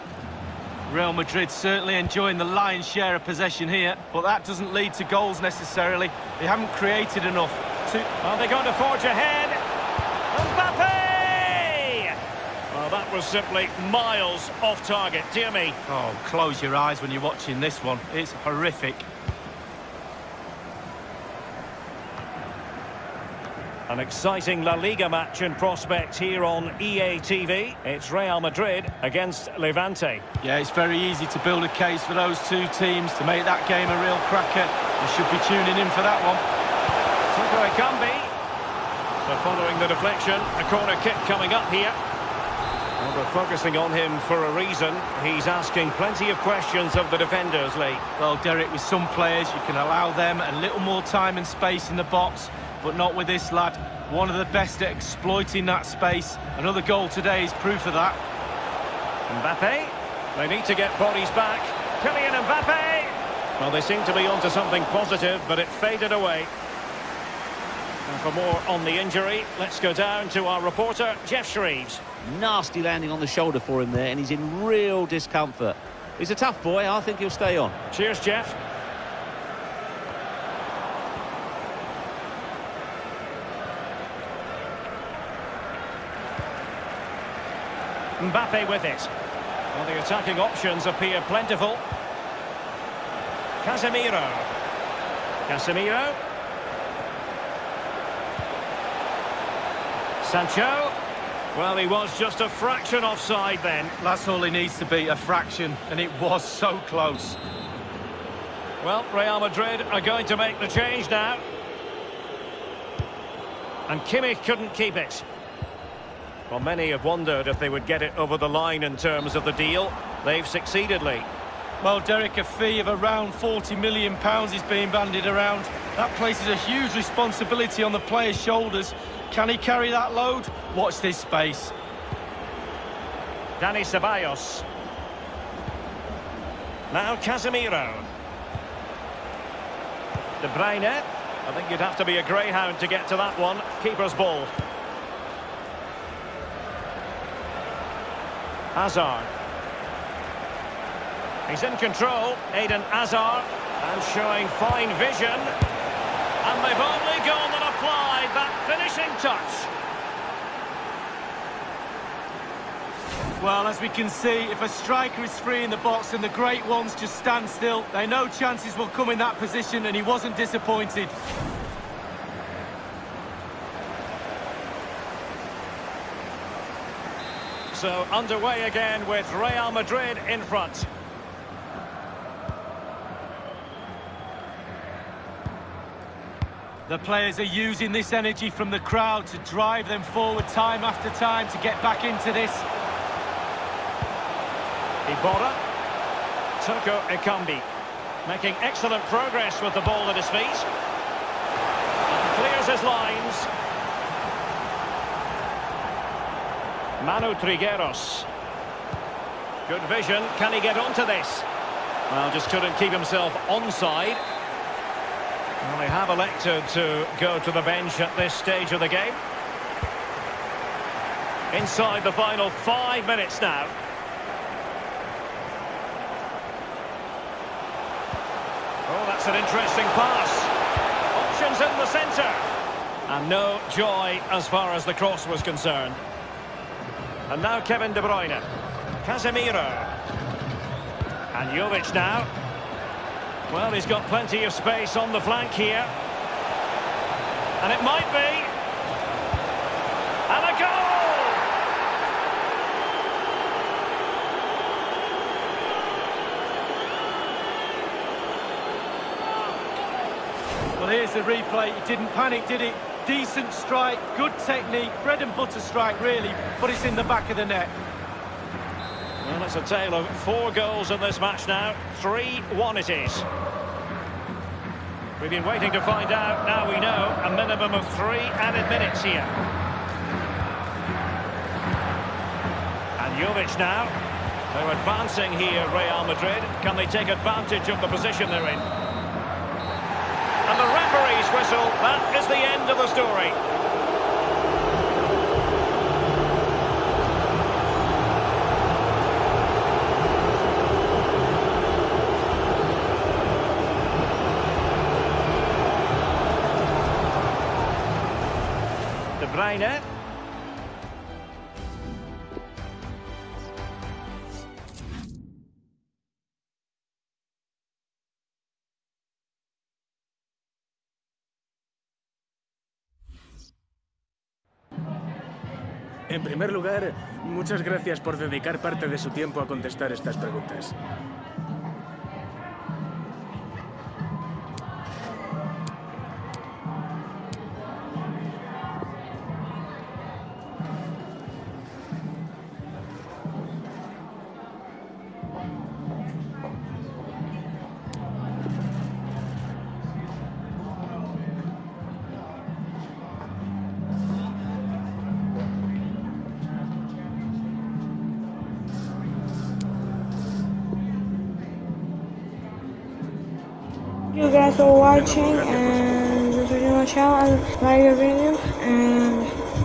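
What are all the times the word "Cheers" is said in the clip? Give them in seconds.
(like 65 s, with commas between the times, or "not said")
77 s.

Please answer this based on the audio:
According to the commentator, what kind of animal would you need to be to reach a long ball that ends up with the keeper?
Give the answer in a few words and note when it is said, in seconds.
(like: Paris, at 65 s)
Greyhound, at 142 s.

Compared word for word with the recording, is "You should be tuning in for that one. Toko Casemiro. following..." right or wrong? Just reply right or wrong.
wrong.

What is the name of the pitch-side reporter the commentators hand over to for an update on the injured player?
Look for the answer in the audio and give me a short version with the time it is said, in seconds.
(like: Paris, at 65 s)
Geoff Shreeves, at 71 s.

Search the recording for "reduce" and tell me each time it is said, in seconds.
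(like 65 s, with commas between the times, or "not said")
not said.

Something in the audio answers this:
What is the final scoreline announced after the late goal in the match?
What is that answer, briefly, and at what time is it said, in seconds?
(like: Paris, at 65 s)
3-1, at 272 s.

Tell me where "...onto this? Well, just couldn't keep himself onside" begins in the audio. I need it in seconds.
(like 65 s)
210 s.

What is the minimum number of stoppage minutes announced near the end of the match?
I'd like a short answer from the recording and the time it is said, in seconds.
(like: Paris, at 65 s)
3, at 277 s.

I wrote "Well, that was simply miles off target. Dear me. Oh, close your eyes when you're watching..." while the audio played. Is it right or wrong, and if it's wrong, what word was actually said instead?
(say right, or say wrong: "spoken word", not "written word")
right.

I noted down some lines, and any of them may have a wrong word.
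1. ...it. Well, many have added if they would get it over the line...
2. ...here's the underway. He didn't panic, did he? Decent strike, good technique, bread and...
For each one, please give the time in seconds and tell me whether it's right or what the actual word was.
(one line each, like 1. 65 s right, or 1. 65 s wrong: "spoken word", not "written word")
1. 114 s wrong: "wondered", not "added"
2. 260 s wrong: "replay", not "underway".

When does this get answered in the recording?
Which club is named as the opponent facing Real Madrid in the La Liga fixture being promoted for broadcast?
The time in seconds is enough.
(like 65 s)
29 s.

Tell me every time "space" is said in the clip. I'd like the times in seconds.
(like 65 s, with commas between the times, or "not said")
51 s, 55 s, 131 s, 244 s.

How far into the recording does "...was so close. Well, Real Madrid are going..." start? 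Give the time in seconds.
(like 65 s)
106 s.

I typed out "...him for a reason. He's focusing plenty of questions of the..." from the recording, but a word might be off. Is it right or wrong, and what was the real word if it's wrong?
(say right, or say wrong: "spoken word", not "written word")
wrong: "asking", not "focusing".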